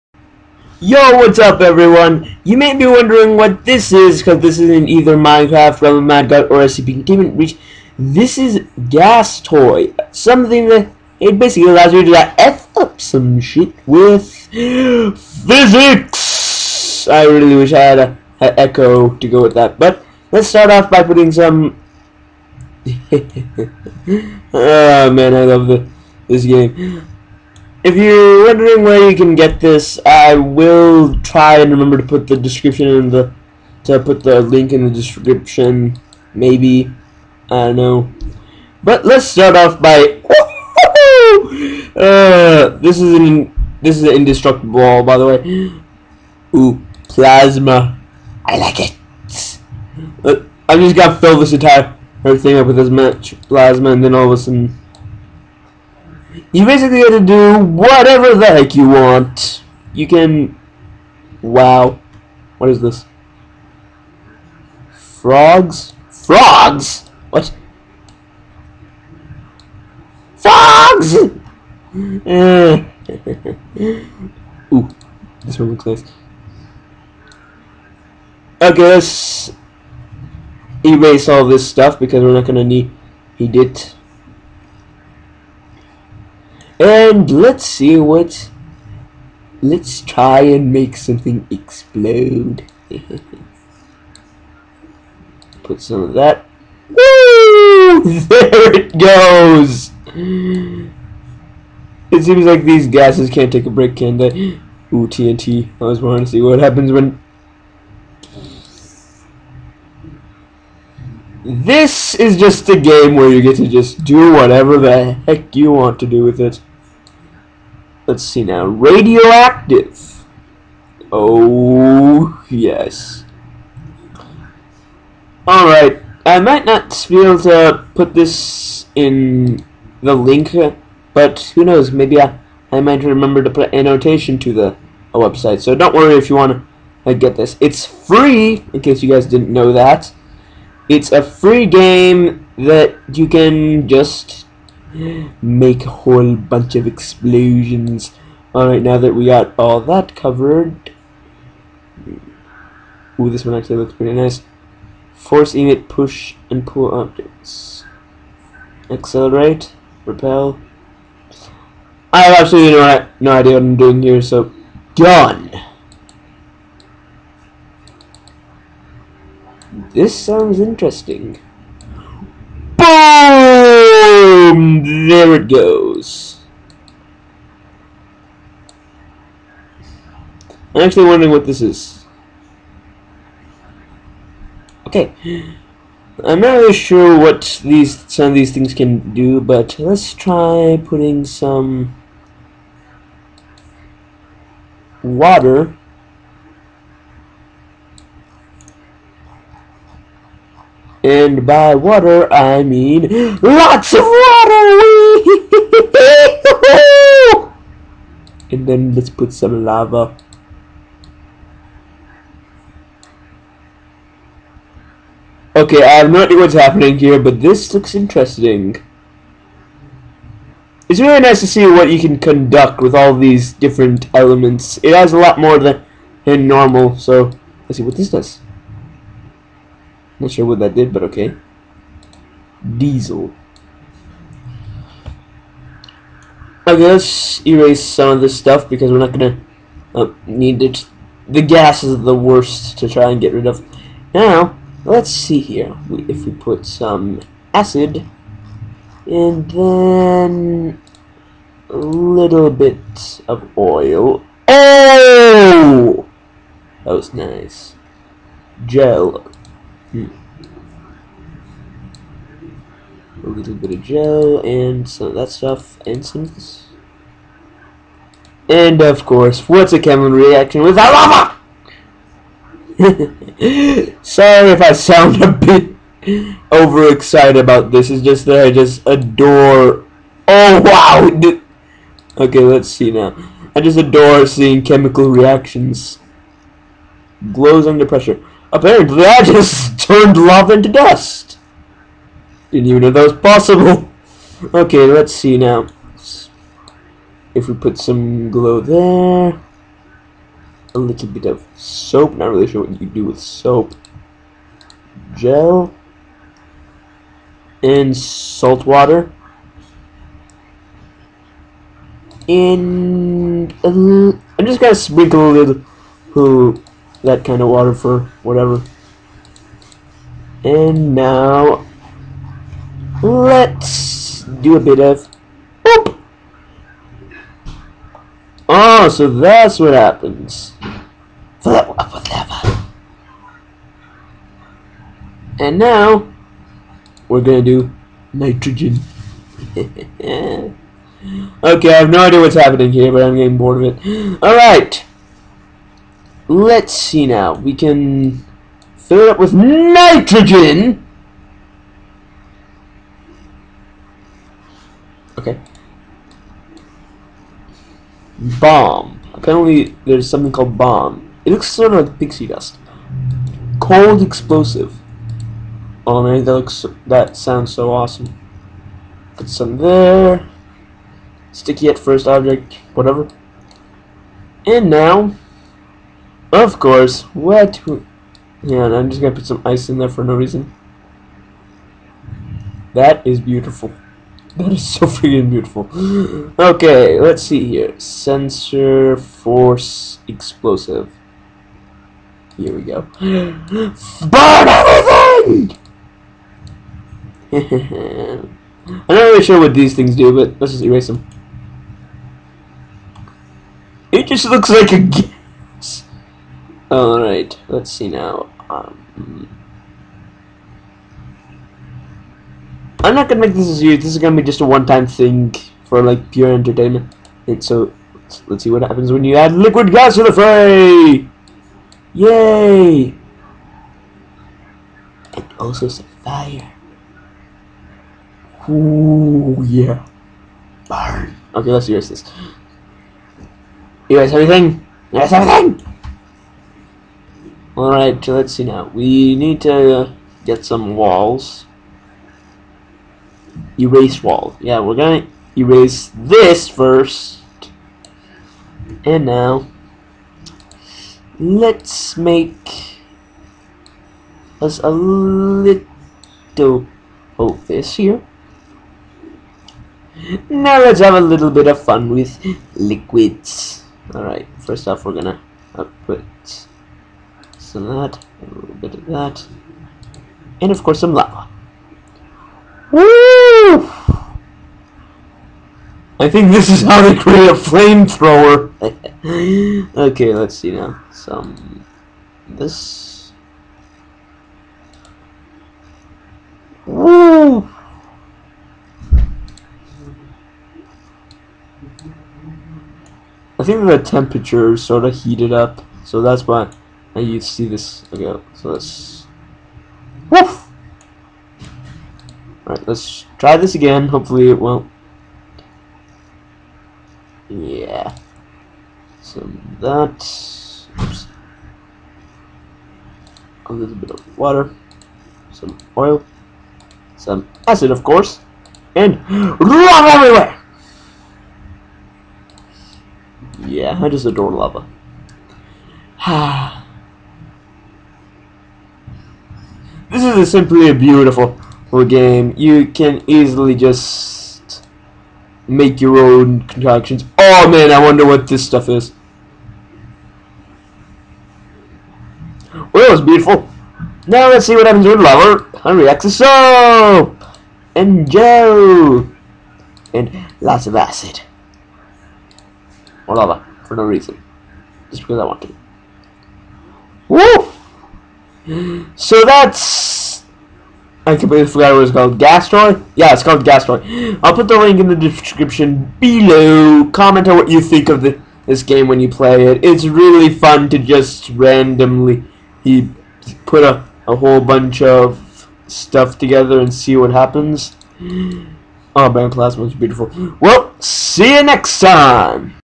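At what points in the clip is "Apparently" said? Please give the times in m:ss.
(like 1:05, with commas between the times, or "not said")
4:48, 5:59.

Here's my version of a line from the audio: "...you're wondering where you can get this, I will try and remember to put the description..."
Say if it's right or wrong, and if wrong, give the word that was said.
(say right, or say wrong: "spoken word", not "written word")
right.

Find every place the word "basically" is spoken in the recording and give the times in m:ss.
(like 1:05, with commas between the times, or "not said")
0:11, 0:56.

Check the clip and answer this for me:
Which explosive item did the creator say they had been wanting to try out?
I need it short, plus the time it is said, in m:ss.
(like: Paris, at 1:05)
TNT, at 1:45.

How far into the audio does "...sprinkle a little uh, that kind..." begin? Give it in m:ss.
5:14.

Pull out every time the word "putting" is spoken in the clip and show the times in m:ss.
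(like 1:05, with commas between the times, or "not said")
0:21, 3:10.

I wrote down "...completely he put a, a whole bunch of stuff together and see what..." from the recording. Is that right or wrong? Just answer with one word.
wrong.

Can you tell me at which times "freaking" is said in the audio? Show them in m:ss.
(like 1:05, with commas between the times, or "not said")
6:24.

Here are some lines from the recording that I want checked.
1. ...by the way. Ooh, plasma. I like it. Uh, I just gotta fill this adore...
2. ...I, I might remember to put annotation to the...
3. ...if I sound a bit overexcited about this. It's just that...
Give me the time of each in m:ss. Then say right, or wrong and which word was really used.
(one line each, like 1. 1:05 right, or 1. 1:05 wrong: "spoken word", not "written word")
1. 0:45 wrong: "entire", not "adore"
2. 2:12 right
3. 4:34 right.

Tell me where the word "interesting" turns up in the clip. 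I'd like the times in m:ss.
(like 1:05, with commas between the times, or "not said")
2:50, 3:37.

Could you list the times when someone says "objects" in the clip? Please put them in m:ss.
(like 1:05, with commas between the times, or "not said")
2:36, 6:12.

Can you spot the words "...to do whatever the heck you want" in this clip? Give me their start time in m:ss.
0:57.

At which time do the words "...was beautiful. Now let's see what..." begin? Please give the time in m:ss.
9:02.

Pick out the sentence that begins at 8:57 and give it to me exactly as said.
Oh man, I wonder what this stuff is.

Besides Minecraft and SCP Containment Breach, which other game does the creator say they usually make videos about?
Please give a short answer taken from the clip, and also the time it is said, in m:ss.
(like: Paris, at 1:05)
Realm of Mad God, at 0:05.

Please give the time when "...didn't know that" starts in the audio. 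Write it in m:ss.
2:19.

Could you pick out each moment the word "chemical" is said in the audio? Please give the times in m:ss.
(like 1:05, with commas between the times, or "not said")
4:29, 4:44.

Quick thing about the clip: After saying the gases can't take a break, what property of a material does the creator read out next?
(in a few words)
radioactive.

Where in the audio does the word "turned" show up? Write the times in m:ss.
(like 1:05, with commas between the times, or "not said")
4:49.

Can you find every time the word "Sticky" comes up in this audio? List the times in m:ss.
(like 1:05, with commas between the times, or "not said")
6:11.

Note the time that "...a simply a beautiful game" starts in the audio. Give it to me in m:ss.
8:50.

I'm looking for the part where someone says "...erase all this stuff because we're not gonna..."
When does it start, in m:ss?
1:20.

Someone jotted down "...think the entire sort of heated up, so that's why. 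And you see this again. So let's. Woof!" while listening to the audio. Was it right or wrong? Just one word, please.
wrong.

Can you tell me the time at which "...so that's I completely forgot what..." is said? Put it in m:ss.
9:18.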